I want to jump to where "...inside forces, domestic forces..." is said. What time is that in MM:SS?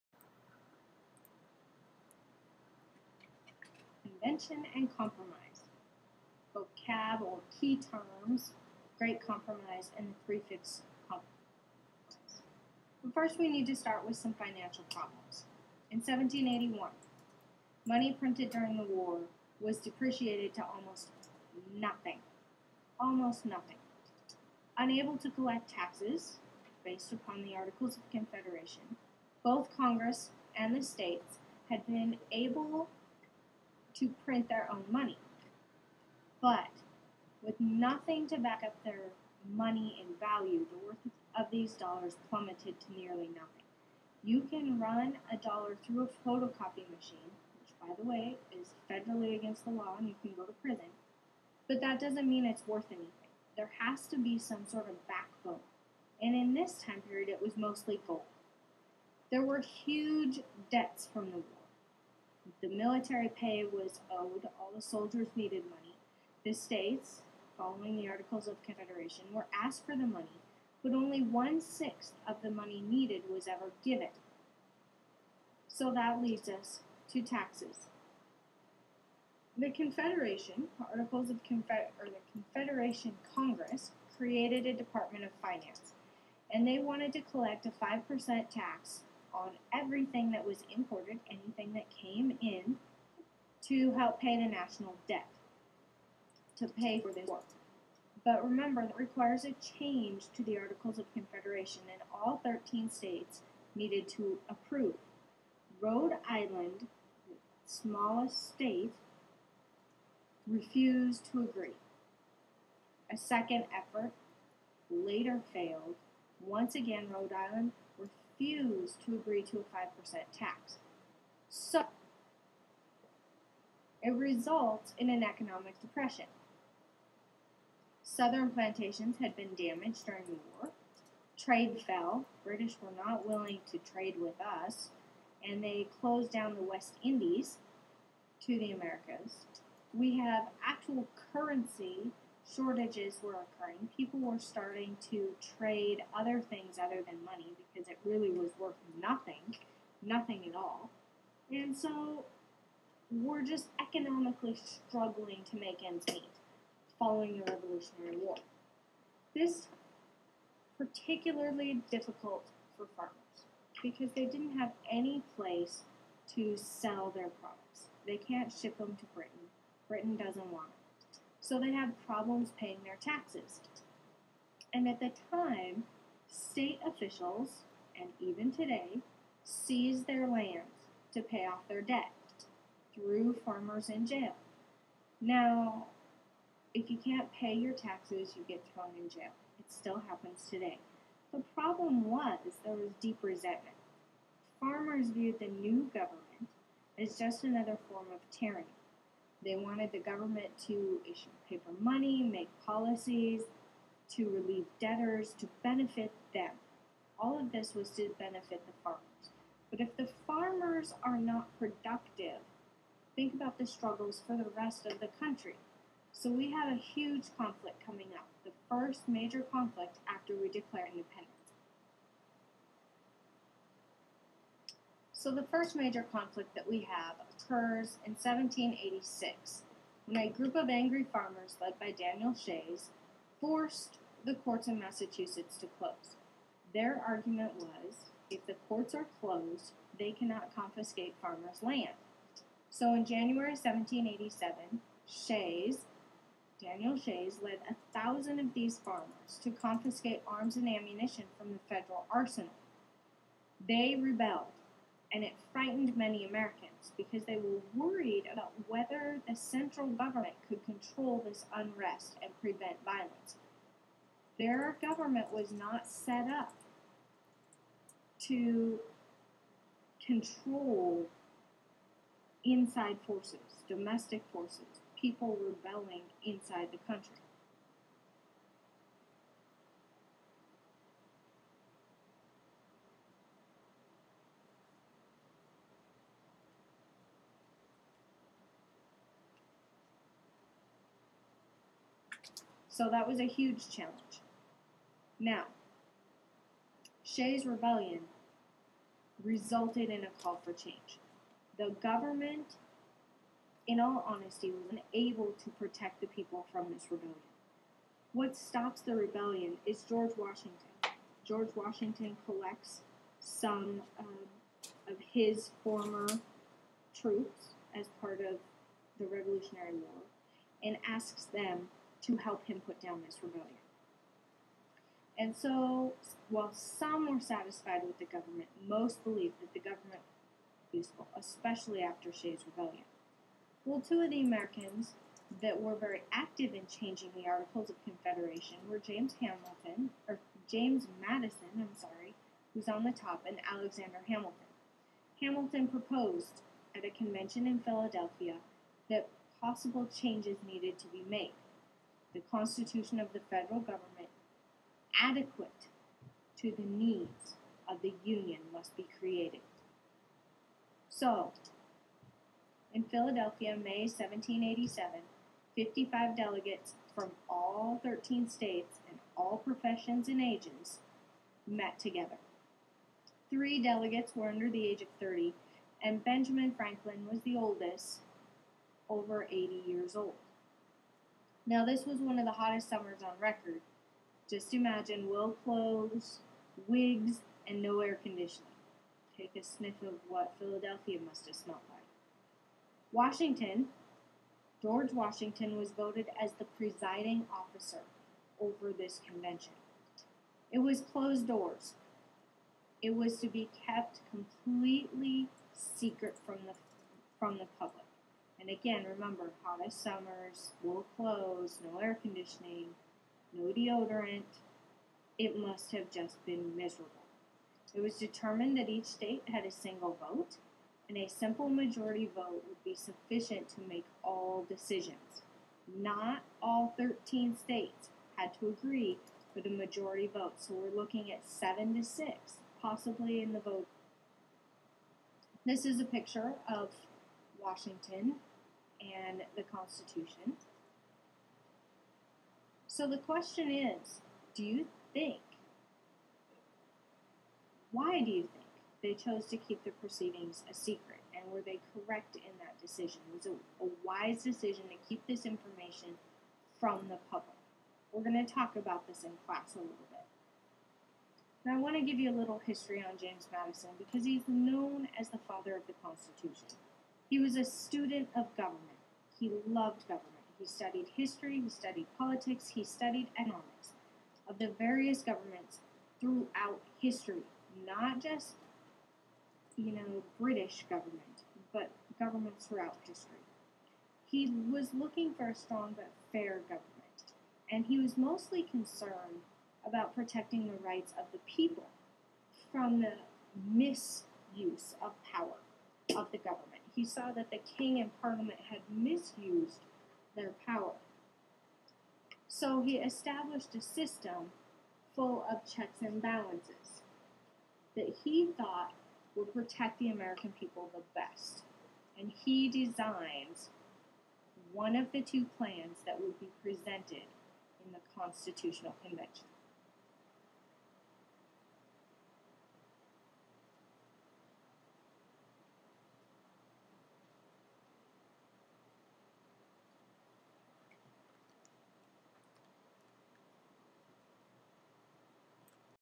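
04:32.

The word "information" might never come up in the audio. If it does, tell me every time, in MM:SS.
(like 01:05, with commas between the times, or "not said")
07:35.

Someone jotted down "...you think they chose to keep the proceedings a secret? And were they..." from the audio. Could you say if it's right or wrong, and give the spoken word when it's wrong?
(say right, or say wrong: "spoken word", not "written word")
right.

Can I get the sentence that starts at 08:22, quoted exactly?
So he established a system full of checks and balances that he thought would protect the American people the best.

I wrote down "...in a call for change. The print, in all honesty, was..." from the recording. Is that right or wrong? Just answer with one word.
wrong.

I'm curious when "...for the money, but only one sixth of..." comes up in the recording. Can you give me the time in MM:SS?
01:09.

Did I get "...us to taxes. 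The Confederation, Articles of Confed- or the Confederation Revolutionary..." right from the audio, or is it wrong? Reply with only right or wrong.
wrong.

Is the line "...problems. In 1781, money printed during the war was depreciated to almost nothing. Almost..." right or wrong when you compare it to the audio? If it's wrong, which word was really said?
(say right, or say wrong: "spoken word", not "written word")
right.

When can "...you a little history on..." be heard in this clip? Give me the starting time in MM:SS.
07:41.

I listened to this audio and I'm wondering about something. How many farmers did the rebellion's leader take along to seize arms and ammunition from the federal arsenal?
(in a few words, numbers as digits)
1,000.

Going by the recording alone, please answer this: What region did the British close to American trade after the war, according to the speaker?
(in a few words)
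the West Indies.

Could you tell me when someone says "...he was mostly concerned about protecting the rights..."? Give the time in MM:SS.
08:07.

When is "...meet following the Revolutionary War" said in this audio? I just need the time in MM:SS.
02:36.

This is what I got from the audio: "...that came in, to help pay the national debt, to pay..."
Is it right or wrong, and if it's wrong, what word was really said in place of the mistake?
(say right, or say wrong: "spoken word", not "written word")
right.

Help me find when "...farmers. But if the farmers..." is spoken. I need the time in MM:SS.
03:28.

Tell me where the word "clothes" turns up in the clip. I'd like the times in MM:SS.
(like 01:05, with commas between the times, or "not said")
06:25, 06:50.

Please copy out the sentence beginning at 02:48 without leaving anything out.
They can't ship them to Britain.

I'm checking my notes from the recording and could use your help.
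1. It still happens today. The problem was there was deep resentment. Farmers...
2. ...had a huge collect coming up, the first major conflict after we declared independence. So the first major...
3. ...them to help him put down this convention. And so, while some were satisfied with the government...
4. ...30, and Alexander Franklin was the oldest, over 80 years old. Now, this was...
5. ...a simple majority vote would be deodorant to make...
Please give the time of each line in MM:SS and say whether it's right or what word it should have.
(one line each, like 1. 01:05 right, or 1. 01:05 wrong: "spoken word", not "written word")
1. 03:09 right
2. 03:36 wrong: "conflict", not "collect"
3. 05:21 wrong: "rebellion", not "convention"
4. 06:14 wrong: "Benjamin", not "Alexander"
5. 07:00 wrong: "sufficient", not "deodorant".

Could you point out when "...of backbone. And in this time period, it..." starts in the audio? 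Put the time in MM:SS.
00:54.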